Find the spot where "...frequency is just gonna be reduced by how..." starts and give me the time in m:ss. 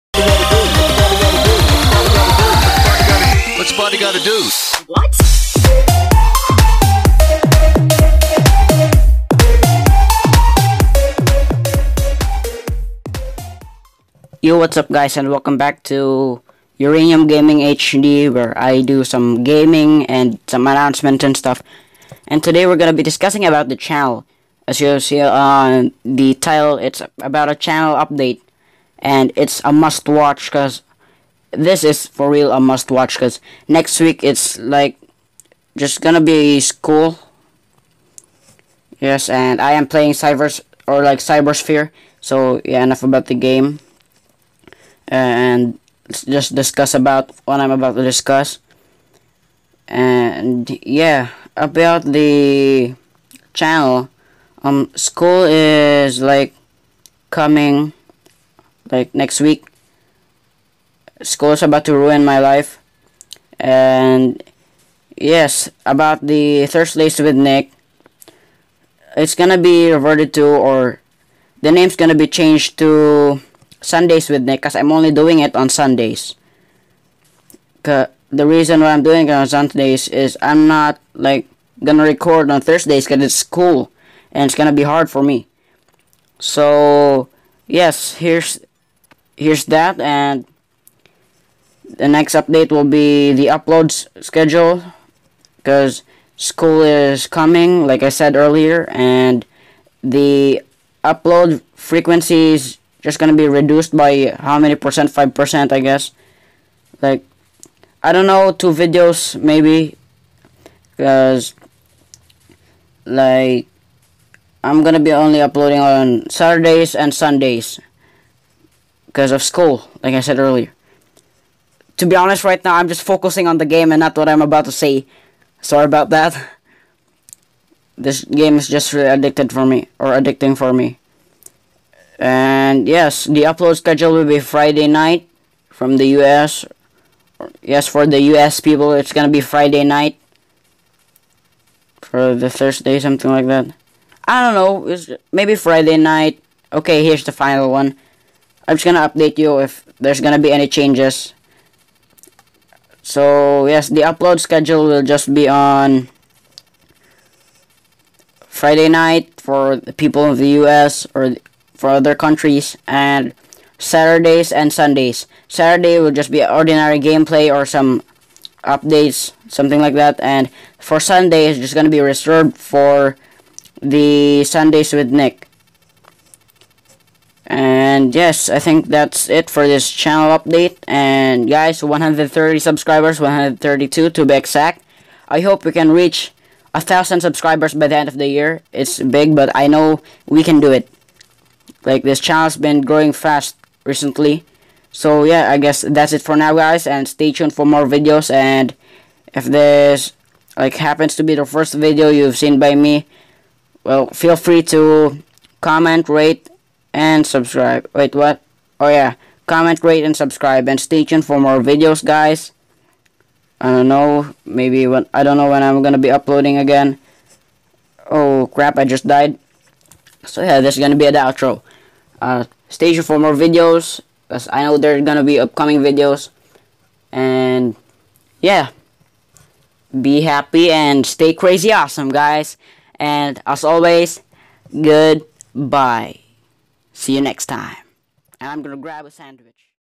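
1:41.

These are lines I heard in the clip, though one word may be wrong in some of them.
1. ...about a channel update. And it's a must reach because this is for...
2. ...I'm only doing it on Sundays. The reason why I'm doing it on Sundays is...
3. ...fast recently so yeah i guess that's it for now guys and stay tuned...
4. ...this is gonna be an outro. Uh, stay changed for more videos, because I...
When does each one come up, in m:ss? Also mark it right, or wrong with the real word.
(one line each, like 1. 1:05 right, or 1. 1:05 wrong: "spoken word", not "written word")
1. 0:27 wrong: "watch", not "reach"
2. 1:14 right
3. 3:13 right
4. 3:40 wrong: "tuned", not "changed".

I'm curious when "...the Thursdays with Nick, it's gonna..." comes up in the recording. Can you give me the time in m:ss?
1:06.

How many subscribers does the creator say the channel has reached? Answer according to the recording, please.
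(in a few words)
132.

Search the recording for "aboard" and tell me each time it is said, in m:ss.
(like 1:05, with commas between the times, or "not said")
not said.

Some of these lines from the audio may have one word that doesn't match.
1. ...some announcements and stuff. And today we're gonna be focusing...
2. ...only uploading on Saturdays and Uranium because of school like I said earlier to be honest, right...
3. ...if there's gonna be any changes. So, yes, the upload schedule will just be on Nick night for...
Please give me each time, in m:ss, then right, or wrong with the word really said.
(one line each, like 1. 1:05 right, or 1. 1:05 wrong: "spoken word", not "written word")
1. 0:20 wrong: "discussing", not "focusing"
2. 1:55 wrong: "Sundays", not "Uranium"
3. 2:29 wrong: "Friday", not "Nick".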